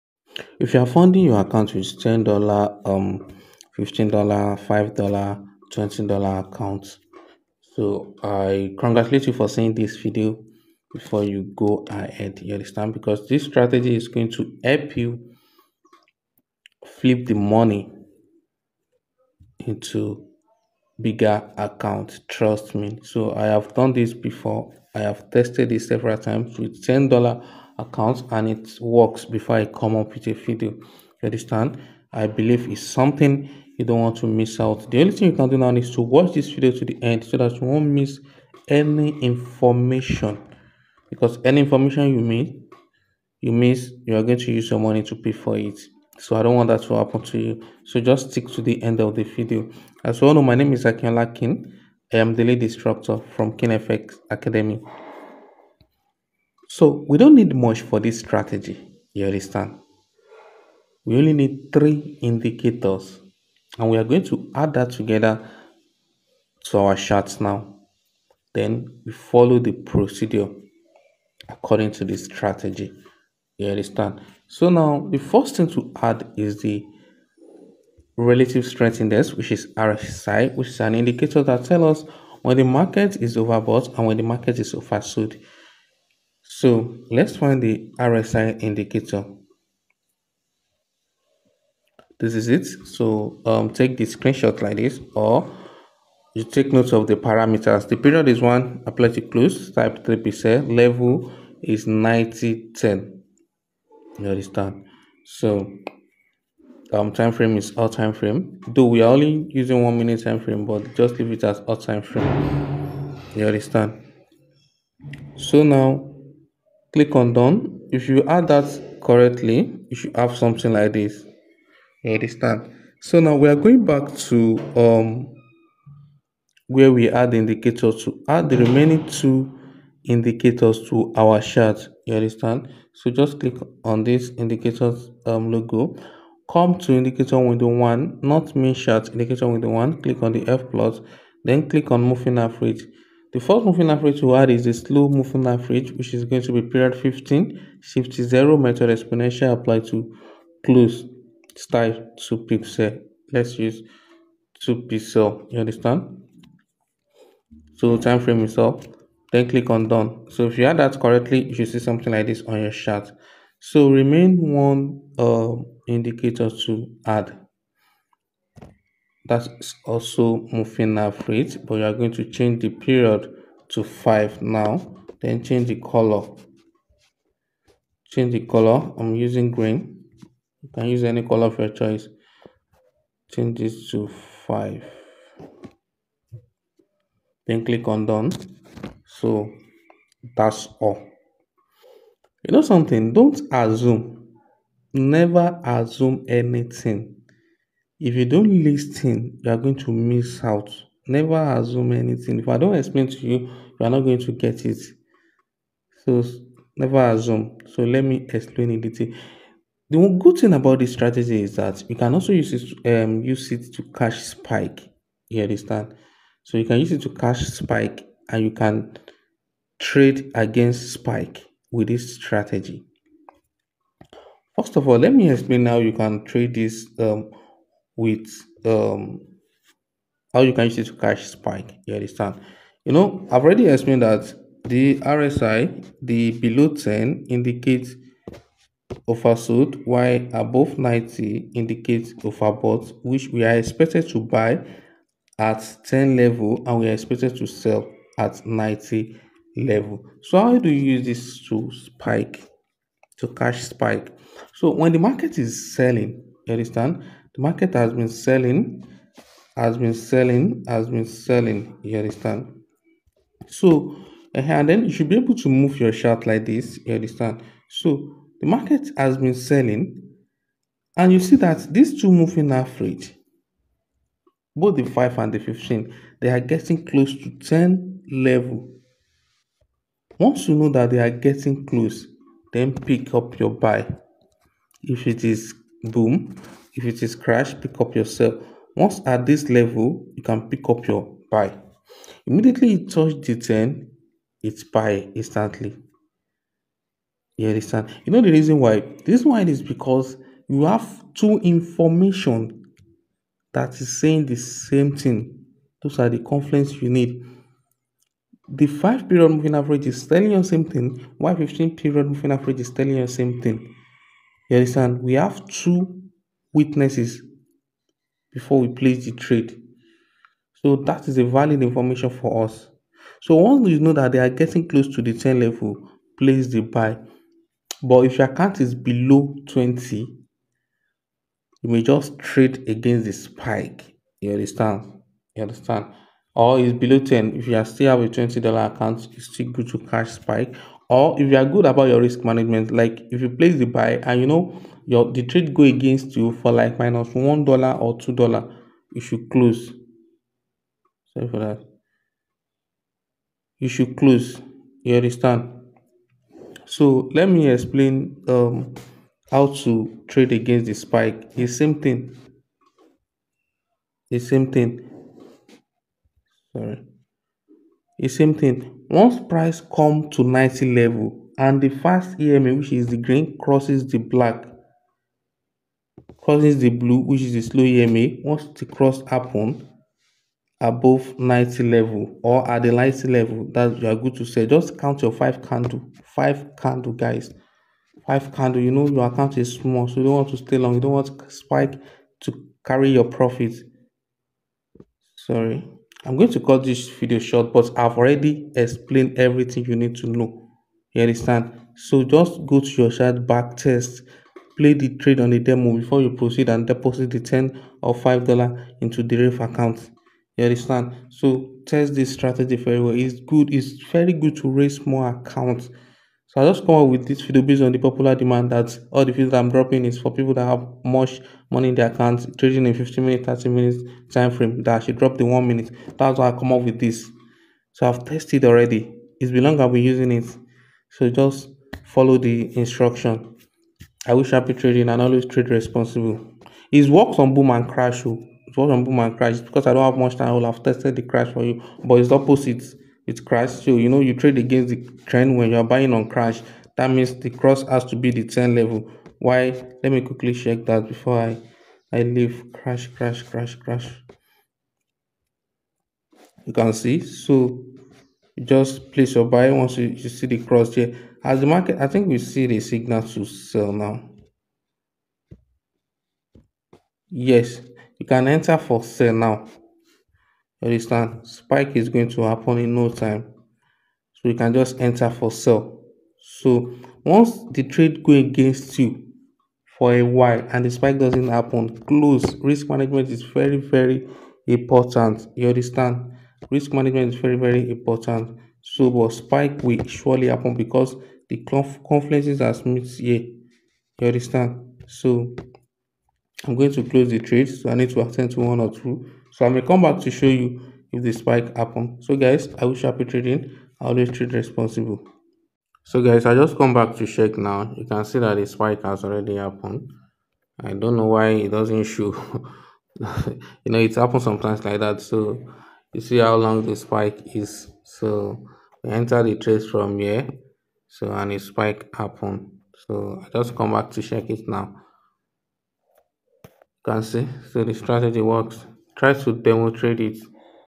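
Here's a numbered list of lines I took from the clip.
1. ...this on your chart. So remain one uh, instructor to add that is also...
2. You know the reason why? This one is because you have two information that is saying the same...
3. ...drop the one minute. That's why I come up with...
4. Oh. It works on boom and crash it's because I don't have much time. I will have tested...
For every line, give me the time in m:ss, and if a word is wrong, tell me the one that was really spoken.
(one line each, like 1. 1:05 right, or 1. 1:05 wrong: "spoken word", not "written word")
1. 2:42 wrong: "indicator", not "instructor"
2. 4:58 right
3. 7:04 right
4. 7:18 right.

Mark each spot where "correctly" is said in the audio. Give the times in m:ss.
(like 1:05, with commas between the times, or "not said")
1:59, 2:40.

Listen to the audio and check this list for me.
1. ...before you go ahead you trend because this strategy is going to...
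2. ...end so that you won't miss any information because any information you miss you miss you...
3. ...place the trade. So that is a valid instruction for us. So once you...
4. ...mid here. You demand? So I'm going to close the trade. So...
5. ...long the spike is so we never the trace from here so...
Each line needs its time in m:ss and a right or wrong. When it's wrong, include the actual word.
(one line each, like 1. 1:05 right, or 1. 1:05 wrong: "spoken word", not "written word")
1. 0:10 wrong: "understand", not "trend"
2. 0:37 right
3. 5:18 wrong: "information", not "instruction"
4. 8:12 wrong: "understand", not "demand"
5. 8:36 wrong: "enter", not "never".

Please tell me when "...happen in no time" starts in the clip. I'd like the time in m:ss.
7:52.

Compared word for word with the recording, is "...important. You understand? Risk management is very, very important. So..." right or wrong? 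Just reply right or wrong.
right.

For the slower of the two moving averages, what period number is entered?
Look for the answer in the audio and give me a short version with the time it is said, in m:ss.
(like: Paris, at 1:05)
15, at 2:26.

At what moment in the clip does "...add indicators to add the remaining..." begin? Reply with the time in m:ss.
2:07.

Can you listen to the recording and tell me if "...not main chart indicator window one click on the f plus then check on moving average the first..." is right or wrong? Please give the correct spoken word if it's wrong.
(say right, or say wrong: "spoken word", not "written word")
wrong: "click", not "check".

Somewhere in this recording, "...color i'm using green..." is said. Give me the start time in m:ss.
2:58.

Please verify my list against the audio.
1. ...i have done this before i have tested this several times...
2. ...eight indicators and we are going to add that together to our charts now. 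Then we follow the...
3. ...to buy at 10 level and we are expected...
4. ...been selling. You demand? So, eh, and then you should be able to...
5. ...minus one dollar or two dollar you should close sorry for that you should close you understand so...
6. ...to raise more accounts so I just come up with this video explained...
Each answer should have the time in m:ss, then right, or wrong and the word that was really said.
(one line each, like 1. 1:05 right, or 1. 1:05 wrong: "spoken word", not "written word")
1. 0:23 right
2. 1:01 wrong: "three", not "eight"
3. 4:04 right
4. 4:20 wrong: "understand", not "demand"
5. 5:46 right
6. 6:54 wrong: "based", not "explained".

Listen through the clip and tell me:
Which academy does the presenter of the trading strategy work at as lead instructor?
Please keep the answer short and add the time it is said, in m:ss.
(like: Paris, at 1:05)
Keen FX academy, at 0:53.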